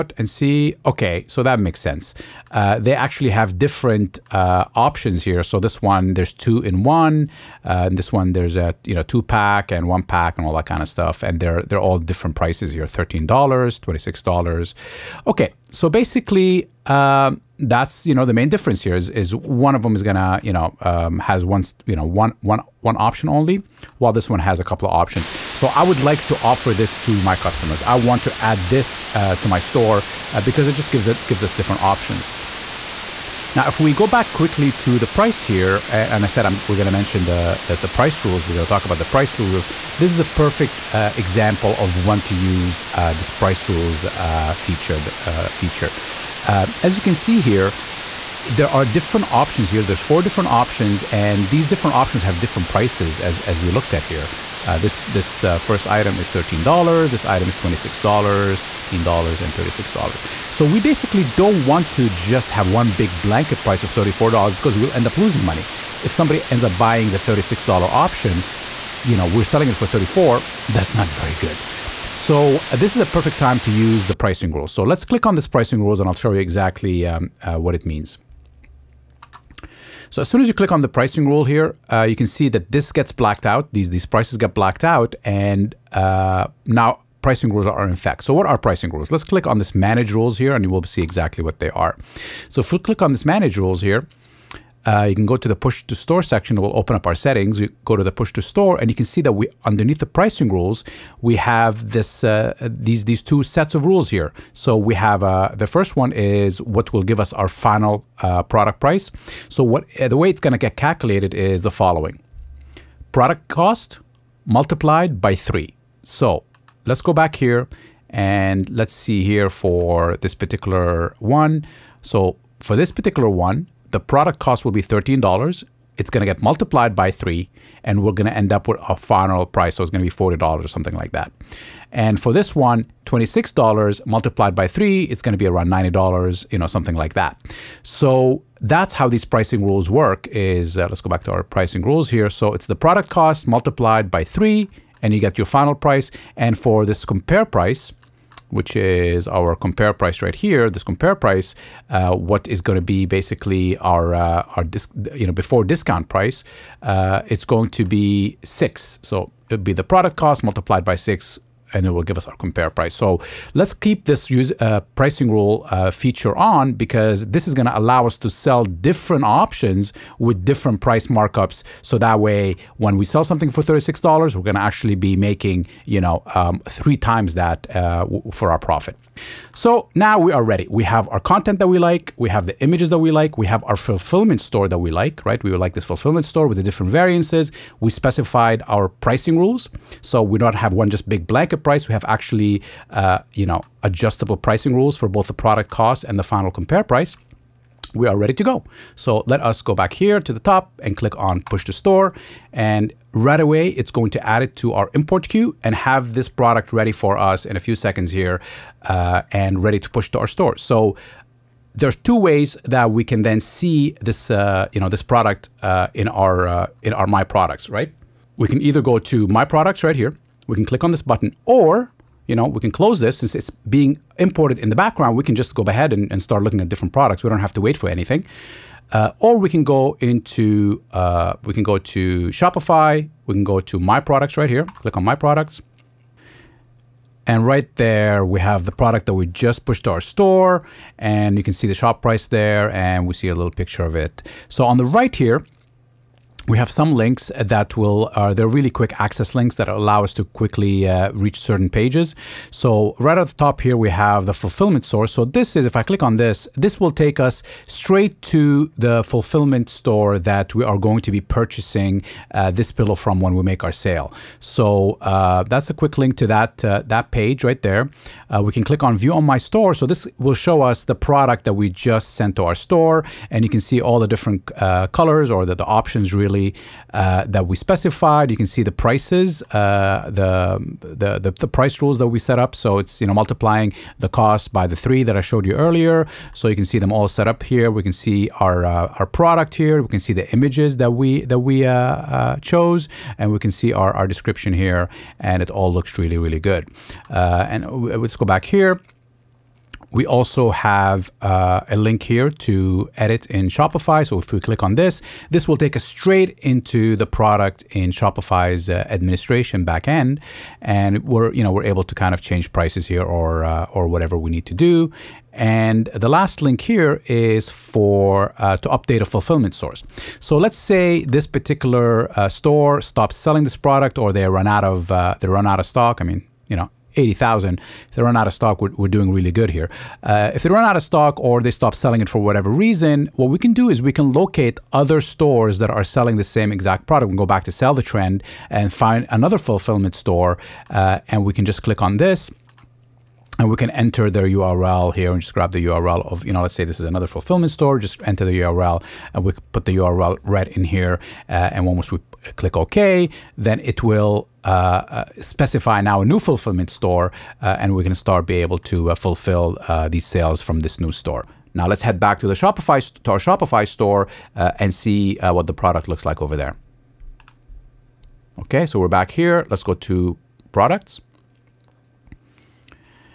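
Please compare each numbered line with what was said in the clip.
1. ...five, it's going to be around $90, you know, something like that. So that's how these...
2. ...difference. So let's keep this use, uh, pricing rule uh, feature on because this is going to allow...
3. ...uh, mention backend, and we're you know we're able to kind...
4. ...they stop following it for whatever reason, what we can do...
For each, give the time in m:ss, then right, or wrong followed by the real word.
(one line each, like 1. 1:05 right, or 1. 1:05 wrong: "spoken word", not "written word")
1. 2:14 wrong: "three", not "five"
2. 2:42 wrong: "price", not "difference"
3. 5:08 wrong: "administration", not "mention"
4. 5:31 wrong: "selling", not "following".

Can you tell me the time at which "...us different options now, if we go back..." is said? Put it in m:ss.
0:31.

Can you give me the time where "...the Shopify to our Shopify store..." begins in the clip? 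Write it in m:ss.
6:02.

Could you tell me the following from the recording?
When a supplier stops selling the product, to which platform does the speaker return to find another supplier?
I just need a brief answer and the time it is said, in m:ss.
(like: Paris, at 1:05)
Sell The Trend, at 5:37.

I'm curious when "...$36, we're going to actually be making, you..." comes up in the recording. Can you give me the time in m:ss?
2:53.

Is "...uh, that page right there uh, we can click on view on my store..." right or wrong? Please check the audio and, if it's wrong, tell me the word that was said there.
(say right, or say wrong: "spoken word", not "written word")
right.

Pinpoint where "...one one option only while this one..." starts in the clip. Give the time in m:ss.
0:22.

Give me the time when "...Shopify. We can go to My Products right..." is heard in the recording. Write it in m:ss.
3:52.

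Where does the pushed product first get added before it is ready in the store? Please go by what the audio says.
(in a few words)
import queue.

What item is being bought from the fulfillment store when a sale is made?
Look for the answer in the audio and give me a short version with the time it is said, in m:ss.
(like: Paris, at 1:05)
pillow, at 4:22.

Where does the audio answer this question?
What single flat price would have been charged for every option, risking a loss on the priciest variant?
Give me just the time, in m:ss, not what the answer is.
1:03.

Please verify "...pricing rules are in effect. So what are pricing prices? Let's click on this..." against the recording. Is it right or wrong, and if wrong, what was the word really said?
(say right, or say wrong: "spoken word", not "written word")
wrong: "rules", not "prices".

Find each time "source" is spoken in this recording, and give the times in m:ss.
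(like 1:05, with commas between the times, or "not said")
4:14, 5:19.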